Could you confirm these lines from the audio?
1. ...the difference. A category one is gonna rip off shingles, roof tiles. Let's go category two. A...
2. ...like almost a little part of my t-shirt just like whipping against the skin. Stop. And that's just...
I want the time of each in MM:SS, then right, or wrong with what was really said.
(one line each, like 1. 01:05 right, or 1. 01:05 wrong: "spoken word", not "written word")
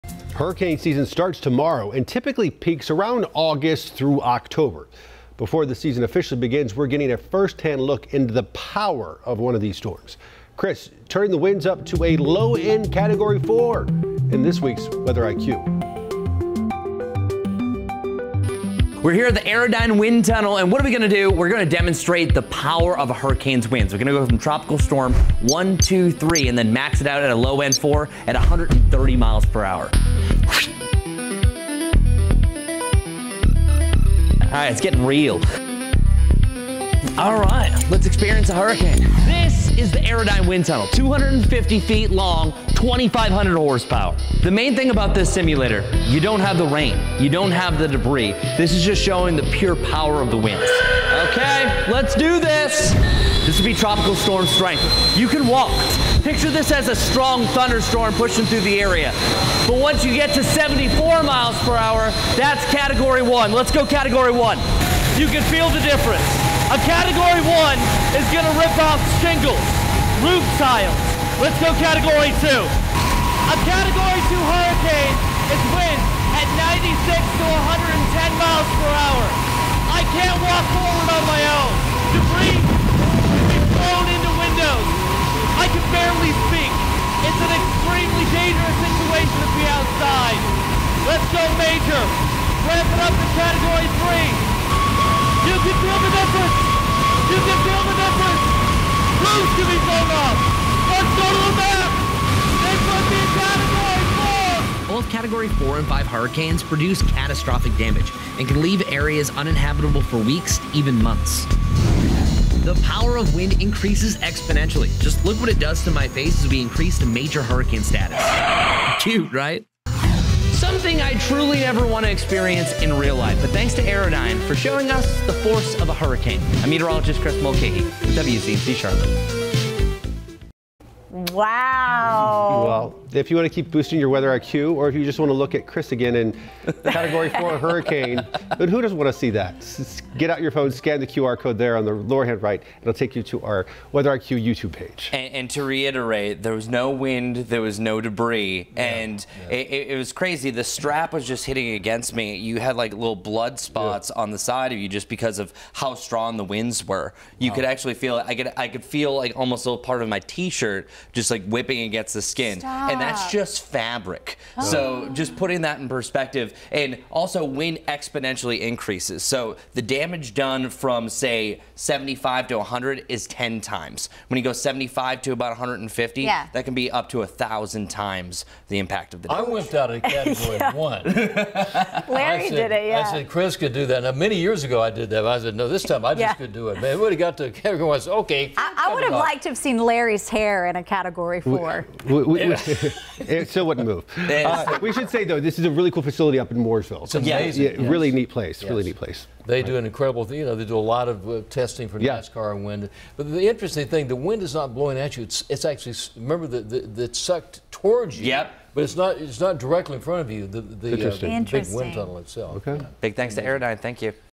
1. 01:05 right
2. 02:39 right.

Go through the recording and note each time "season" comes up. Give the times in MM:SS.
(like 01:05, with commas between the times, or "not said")
00:00, 00:05.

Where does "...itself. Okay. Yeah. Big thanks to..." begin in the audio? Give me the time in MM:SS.
03:32.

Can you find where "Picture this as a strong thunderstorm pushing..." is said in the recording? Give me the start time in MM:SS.
00:56.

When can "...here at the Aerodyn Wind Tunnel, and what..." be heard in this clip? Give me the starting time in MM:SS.
00:19.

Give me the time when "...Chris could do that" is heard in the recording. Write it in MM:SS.
03:03.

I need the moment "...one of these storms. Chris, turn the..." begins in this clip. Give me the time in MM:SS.
00:09.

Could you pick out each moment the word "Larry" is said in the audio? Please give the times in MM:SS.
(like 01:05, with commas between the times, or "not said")
03:02, 03:09.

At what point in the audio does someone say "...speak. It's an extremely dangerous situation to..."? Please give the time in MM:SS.
01:26.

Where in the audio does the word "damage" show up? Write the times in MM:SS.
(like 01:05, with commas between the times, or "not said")
01:47, 02:49, 02:59.